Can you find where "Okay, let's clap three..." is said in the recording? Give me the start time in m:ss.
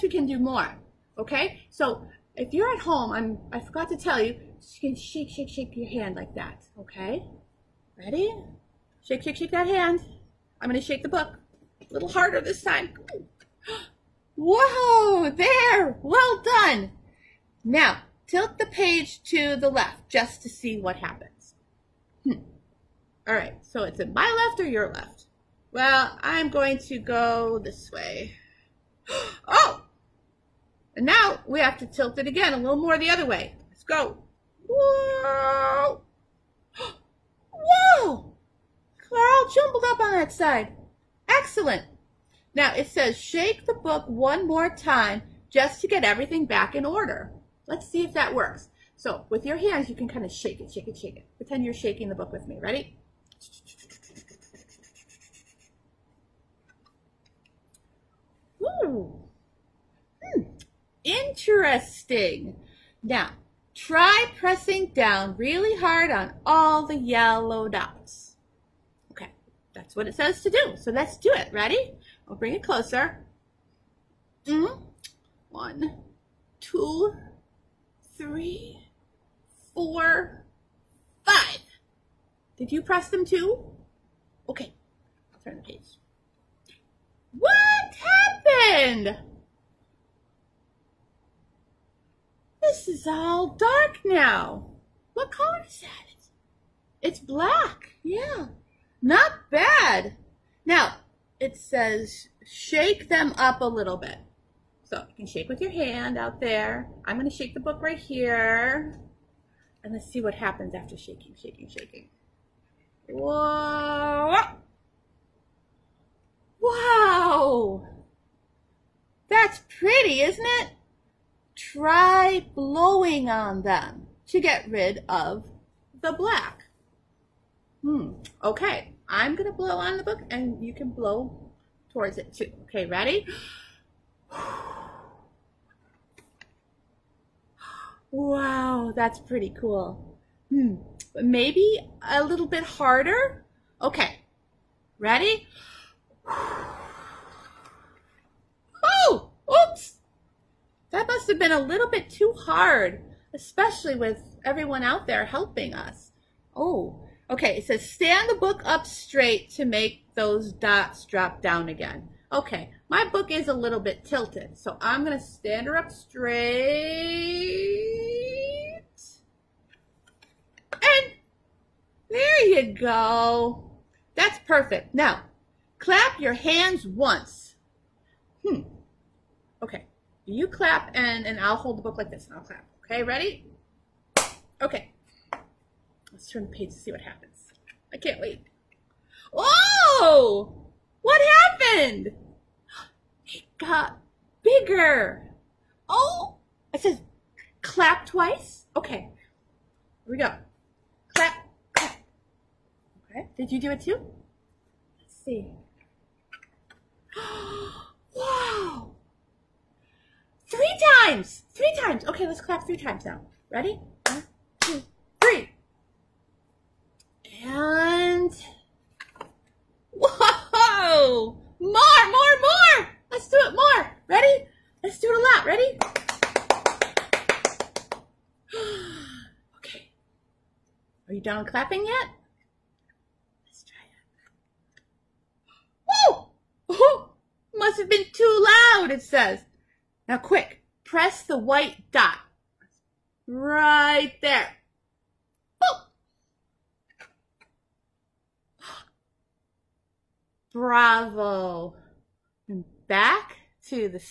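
3:32.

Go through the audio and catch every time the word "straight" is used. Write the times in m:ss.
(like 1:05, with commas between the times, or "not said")
2:38, 2:45.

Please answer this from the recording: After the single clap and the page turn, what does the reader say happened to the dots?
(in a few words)
It got bigger.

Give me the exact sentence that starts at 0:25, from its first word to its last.
Well, I'm going to go this way.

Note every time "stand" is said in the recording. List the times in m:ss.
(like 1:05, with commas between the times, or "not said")
2:37, 2:45.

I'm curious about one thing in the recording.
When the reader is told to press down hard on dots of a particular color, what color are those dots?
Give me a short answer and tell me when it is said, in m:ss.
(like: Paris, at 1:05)
yellow, at 1:06.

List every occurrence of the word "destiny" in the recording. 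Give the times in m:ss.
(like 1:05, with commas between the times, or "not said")
not said.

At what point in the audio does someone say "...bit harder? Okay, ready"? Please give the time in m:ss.
2:22.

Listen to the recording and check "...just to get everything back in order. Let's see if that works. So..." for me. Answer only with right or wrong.
right.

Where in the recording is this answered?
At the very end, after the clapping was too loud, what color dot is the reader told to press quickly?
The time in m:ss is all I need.
4:01.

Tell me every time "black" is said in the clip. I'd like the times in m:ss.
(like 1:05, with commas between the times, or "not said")
1:37, 2:06.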